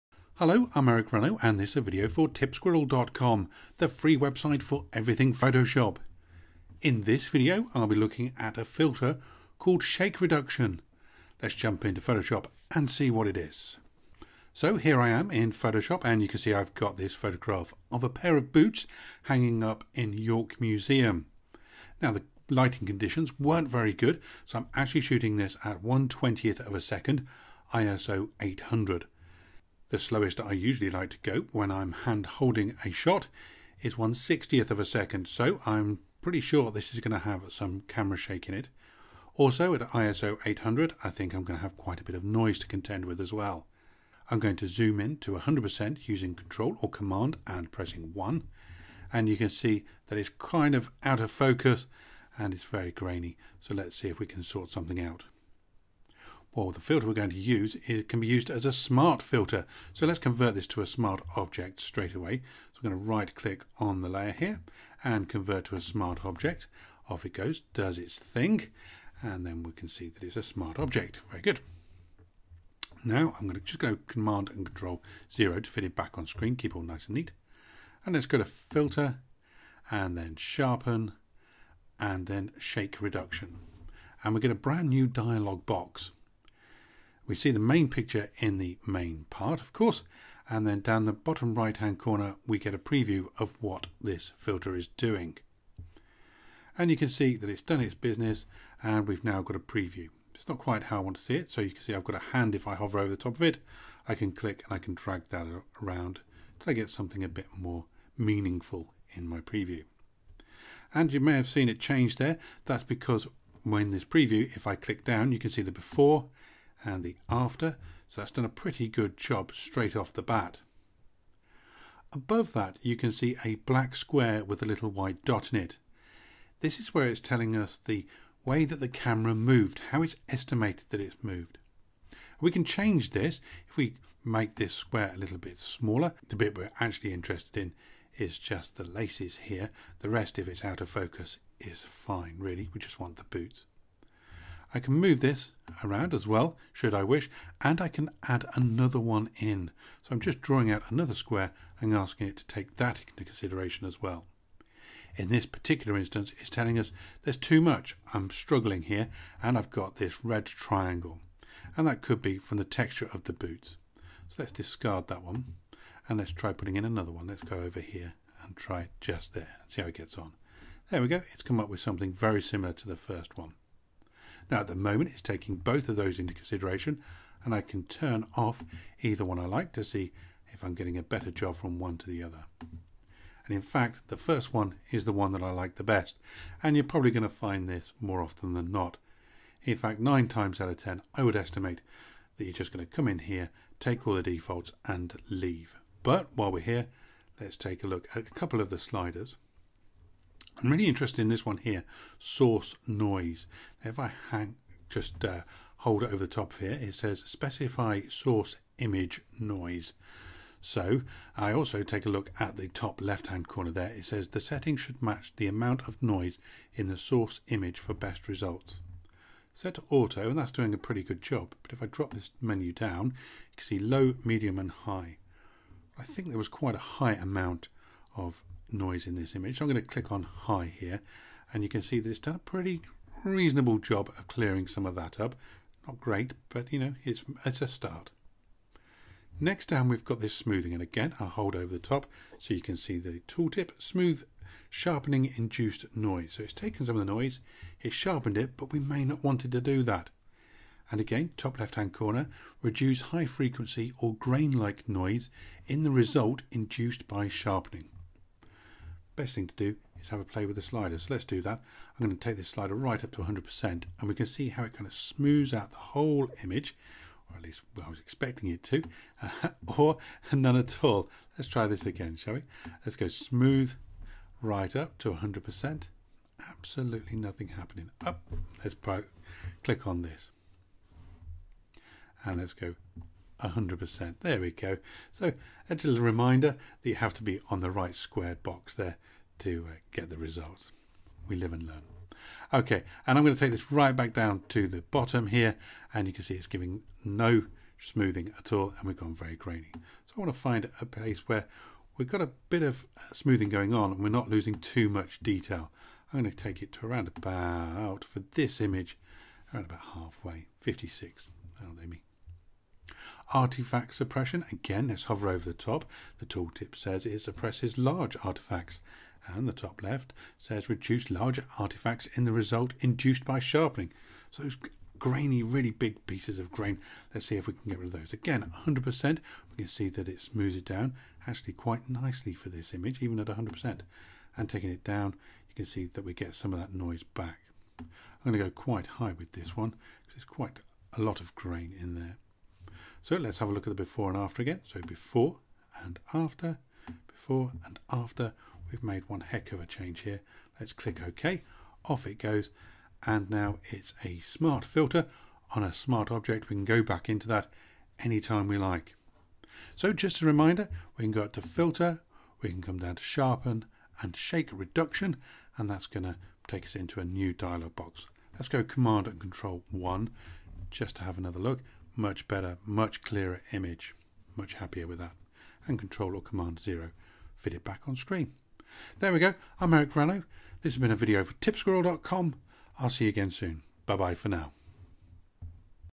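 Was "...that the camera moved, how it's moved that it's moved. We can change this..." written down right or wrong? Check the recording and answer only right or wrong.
wrong.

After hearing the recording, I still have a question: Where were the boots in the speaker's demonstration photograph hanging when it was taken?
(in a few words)
York Museum.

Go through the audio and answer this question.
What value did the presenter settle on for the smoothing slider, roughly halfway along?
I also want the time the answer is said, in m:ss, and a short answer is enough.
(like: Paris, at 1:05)
56, at 5:10.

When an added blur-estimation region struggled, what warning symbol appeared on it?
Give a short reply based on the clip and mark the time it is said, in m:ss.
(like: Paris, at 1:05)
red triangle, at 2:40.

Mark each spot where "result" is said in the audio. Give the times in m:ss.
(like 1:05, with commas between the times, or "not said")
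3:38, 4:15, 4:50, 5:22.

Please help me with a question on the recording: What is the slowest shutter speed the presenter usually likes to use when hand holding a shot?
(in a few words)
1/60th of a second.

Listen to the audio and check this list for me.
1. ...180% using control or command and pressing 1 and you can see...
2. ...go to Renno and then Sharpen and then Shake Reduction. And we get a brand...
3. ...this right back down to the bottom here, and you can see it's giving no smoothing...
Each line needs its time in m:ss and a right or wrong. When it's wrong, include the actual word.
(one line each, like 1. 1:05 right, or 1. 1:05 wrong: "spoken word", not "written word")
1. 0:45 wrong: "100", not "180"
2. 1:18 wrong: "Filter", not "Renno"
3. 4:53 right.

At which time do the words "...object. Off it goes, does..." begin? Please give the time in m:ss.
1:06.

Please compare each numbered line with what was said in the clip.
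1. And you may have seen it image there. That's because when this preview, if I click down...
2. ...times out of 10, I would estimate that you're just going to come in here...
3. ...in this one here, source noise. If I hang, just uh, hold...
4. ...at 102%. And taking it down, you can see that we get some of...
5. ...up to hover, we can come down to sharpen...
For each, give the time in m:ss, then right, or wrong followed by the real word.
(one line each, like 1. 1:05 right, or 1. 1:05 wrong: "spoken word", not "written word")
1. 1:50 wrong: "change", not "image"
2. 3:10 right
3. 3:21 right
4. 5:33 wrong: "100", not "102"
5. 6:01 wrong: "filter", not "hover".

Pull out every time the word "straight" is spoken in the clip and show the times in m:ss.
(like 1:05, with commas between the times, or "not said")
1:01, 1:59.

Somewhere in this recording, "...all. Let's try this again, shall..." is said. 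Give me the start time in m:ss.
4:30.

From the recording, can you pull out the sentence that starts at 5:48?
We've made one heck of a change here.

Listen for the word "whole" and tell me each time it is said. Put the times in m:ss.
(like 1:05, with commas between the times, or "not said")
4:25.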